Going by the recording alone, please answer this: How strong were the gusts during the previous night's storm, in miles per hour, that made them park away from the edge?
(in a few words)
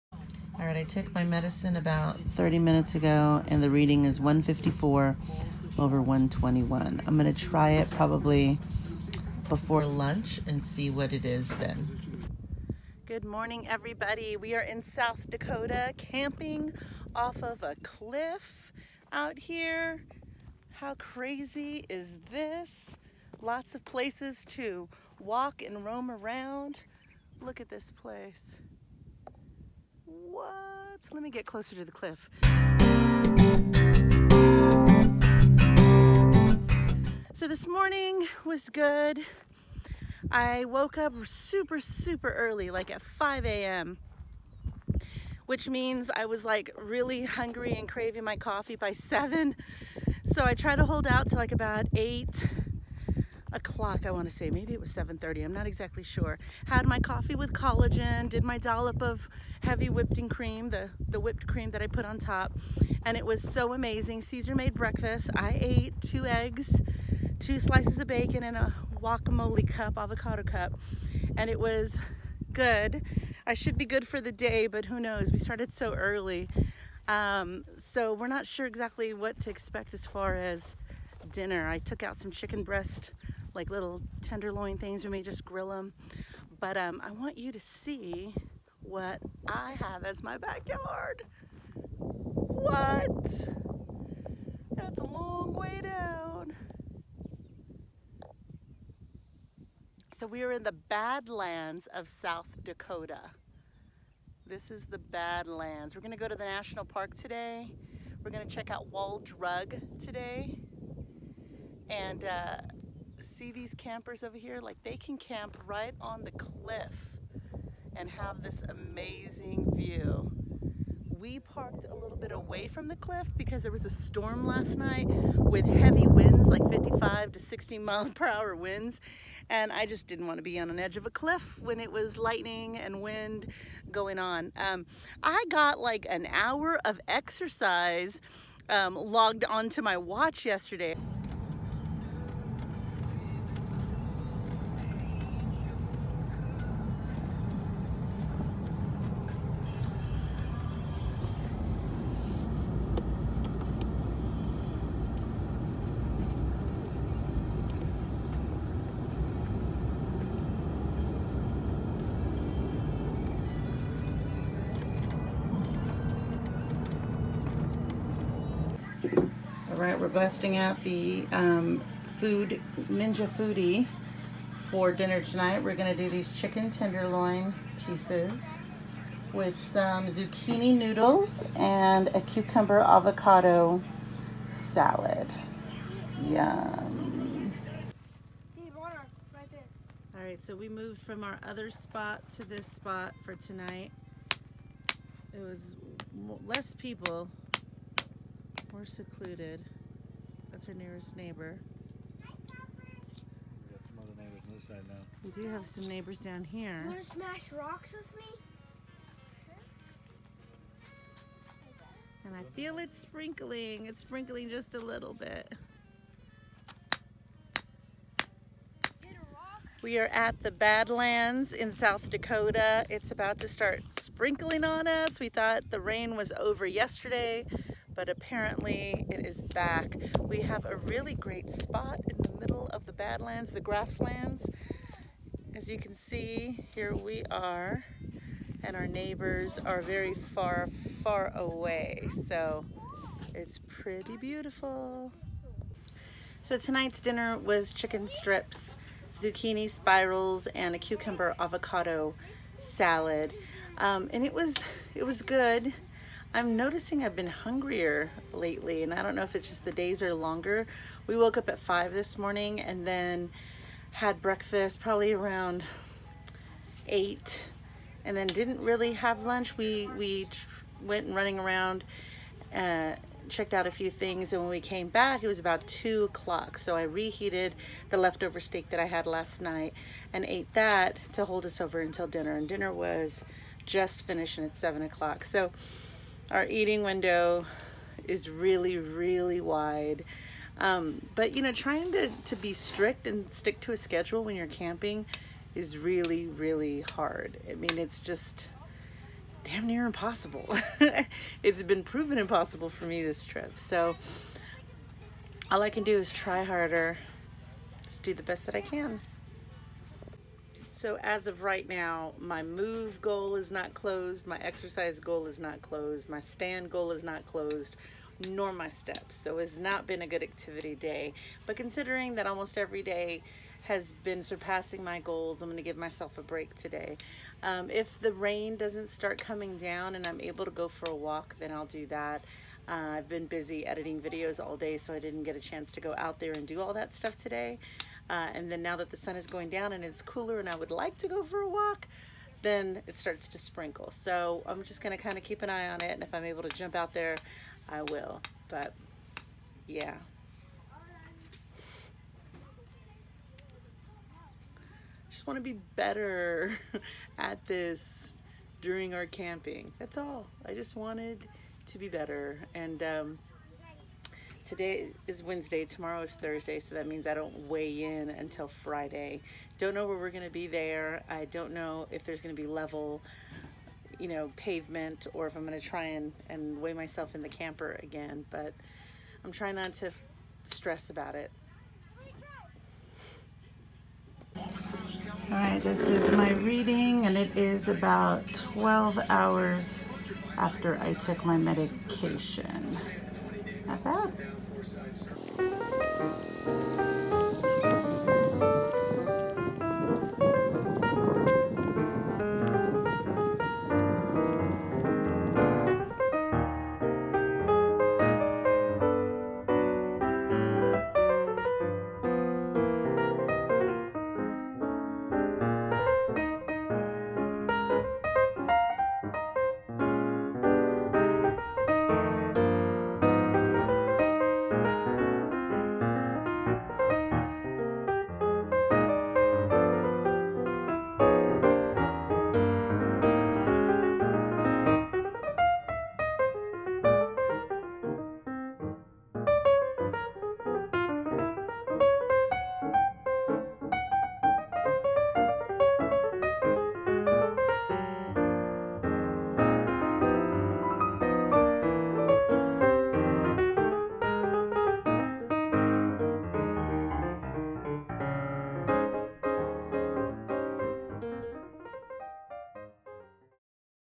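55 to 60.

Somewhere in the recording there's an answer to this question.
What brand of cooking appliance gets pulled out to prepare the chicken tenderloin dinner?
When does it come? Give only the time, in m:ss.
2:52.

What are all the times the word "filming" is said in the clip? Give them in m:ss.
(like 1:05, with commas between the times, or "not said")
not said.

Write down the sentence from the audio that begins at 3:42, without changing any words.
It's about to start sprinkling on us.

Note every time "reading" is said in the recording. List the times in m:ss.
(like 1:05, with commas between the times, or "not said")
0:03, 6:26.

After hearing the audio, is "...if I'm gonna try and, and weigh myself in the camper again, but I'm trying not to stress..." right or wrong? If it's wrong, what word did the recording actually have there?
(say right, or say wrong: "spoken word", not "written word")
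right.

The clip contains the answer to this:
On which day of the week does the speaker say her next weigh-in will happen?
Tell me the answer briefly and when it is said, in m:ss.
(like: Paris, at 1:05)
Friday, at 6:08.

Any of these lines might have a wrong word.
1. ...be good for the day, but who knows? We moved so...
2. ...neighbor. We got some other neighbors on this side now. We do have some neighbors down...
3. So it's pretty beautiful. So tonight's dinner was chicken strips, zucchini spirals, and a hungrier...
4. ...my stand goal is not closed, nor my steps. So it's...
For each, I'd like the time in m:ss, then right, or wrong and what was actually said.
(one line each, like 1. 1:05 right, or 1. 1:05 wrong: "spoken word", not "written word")
1. 1:13 wrong: "started", not "moved"
2. 3:21 right
3. 4:02 wrong: "cucumber", not "hungrier"
4. 5:16 right.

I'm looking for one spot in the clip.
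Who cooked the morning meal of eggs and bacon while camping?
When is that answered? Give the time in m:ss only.
1:04.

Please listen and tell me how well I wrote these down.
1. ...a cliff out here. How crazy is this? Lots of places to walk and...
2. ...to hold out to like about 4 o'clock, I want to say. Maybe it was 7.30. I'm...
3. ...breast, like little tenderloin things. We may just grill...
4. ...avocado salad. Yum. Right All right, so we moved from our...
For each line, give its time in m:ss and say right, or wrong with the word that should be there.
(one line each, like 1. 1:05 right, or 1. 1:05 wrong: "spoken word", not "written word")
1. 0:17 right
2. 0:50 wrong: "8", not "4"
3. 1:22 right
4. 3:02 right.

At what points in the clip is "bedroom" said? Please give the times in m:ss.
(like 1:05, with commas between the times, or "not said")
not said.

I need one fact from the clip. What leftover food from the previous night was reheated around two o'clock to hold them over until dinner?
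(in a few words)
steak.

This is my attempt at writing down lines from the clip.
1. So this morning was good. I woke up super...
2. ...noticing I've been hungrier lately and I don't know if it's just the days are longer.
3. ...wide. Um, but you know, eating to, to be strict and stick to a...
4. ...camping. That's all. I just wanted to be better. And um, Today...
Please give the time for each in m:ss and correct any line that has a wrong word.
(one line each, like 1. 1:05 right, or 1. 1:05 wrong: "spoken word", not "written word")
1. 0:37 right
2. 4:16 right
3. 4:49 wrong: "trying", not "eating"
4. 5:59 right.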